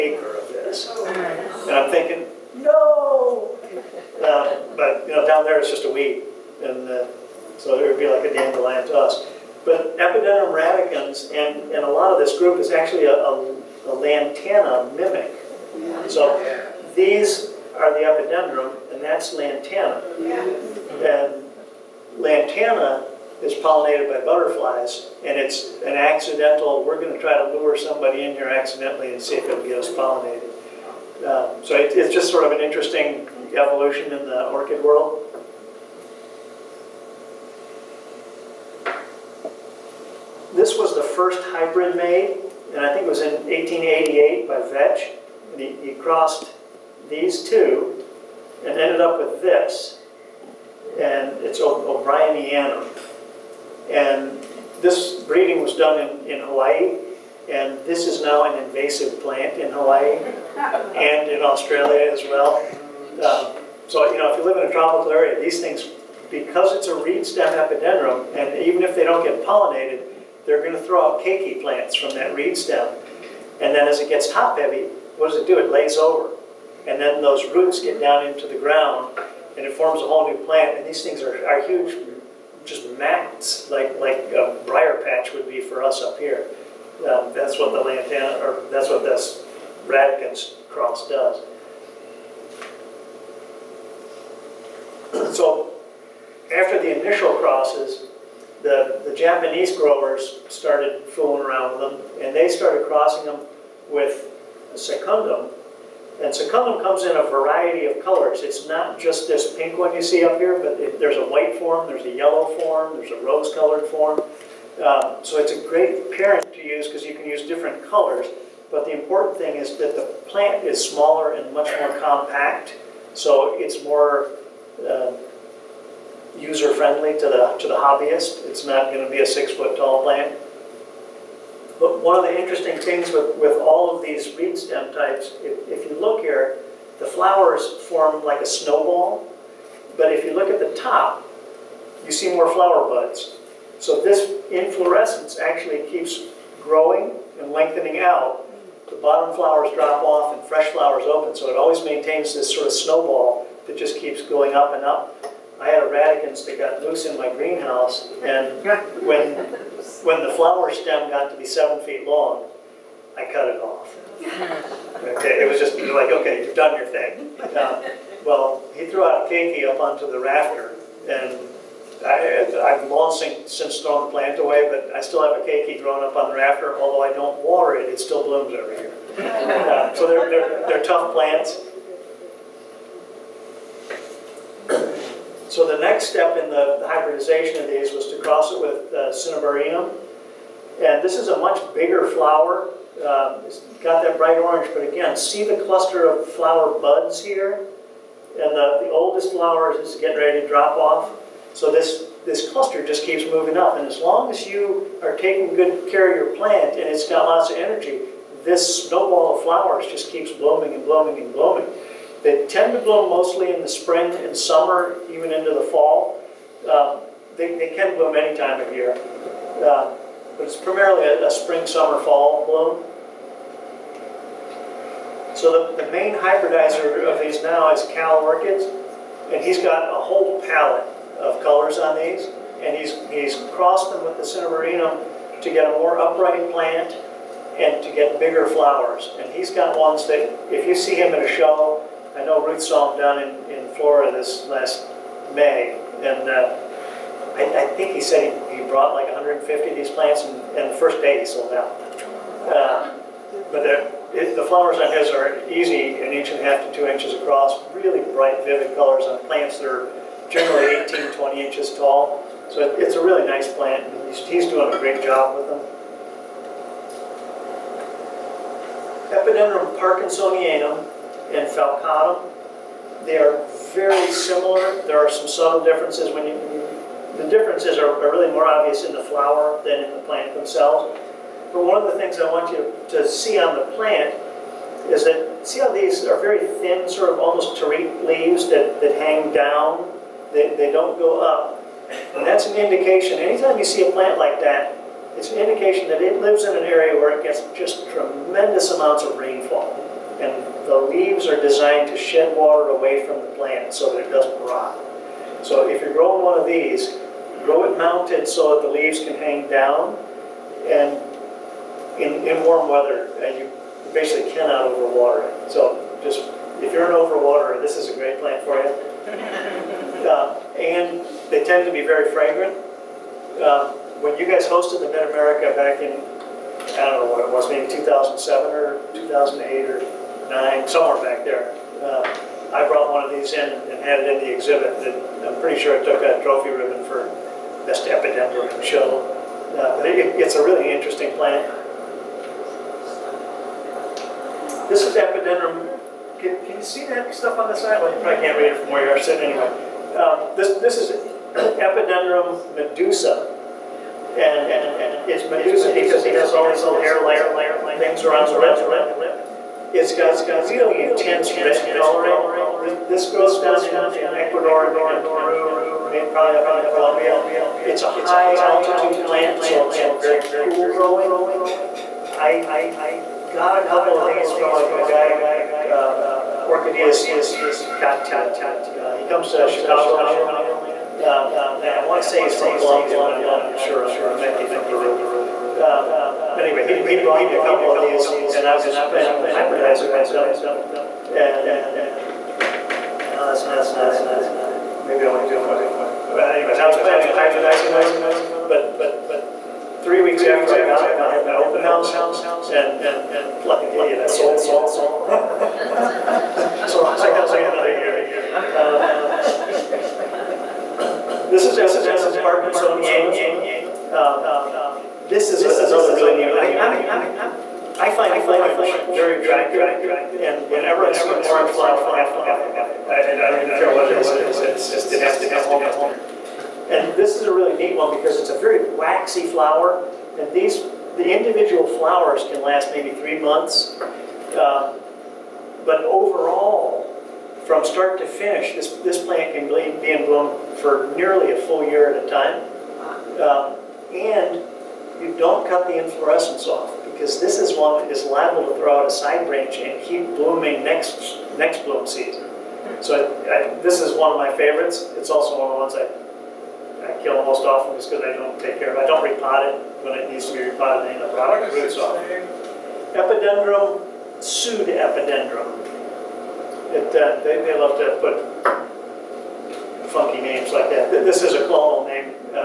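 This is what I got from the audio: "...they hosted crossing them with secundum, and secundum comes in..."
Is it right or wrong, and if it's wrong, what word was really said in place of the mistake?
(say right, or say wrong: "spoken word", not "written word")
wrong: "started", not "hosted".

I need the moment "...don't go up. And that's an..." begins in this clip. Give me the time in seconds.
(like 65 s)
290 s.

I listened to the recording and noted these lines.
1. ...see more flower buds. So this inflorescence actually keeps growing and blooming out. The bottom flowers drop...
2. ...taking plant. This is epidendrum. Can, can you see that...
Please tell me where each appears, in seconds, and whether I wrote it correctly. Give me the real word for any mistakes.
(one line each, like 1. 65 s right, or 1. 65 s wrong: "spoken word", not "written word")
1. 142 s wrong: "lengthening", not "blooming"
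2. 340 s wrong: "interesting", not "taking".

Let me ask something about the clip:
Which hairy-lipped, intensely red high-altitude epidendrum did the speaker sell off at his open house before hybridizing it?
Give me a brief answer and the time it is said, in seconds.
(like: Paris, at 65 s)
Epidendrum medusa, at 351 s.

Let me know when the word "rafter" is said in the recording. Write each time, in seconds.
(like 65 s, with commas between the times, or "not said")
170 s, 176 s.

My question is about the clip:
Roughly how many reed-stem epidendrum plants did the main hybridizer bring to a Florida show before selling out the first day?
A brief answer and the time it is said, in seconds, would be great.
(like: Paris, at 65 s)
150, at 249 s.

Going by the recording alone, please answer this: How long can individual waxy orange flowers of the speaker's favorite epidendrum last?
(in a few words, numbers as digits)
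3 months.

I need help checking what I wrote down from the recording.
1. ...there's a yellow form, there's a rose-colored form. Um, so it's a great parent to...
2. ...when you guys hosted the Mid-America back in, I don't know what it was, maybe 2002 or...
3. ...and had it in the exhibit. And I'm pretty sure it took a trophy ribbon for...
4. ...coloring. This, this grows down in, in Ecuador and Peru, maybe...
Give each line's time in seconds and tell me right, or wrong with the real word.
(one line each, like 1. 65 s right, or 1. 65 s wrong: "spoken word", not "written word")
1. 111 s right
2. 324 s wrong: "2007", not "2002"
3. 333 s right
4. 361 s right.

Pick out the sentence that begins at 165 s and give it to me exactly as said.
Okay, it was just like, okay, you've done your thing.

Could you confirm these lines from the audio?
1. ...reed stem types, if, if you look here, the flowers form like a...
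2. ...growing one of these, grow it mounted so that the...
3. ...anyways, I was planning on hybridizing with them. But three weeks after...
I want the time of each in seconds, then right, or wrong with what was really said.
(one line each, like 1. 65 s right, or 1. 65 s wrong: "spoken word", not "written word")
1. 134 s right
2. 305 s right
3. 396 s right.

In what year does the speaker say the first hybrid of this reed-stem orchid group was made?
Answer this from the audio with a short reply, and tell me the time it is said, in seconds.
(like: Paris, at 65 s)
1888, at 43 s.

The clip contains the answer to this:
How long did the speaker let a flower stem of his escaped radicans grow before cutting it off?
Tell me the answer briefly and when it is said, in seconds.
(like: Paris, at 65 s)
7 feet, at 161 s.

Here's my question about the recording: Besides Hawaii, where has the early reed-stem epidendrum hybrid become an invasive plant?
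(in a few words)
Australia.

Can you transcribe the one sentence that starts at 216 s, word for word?
Um, they, they can bloom any time of year, uh, but it's primarily a, a, spring, summer, fall bloom.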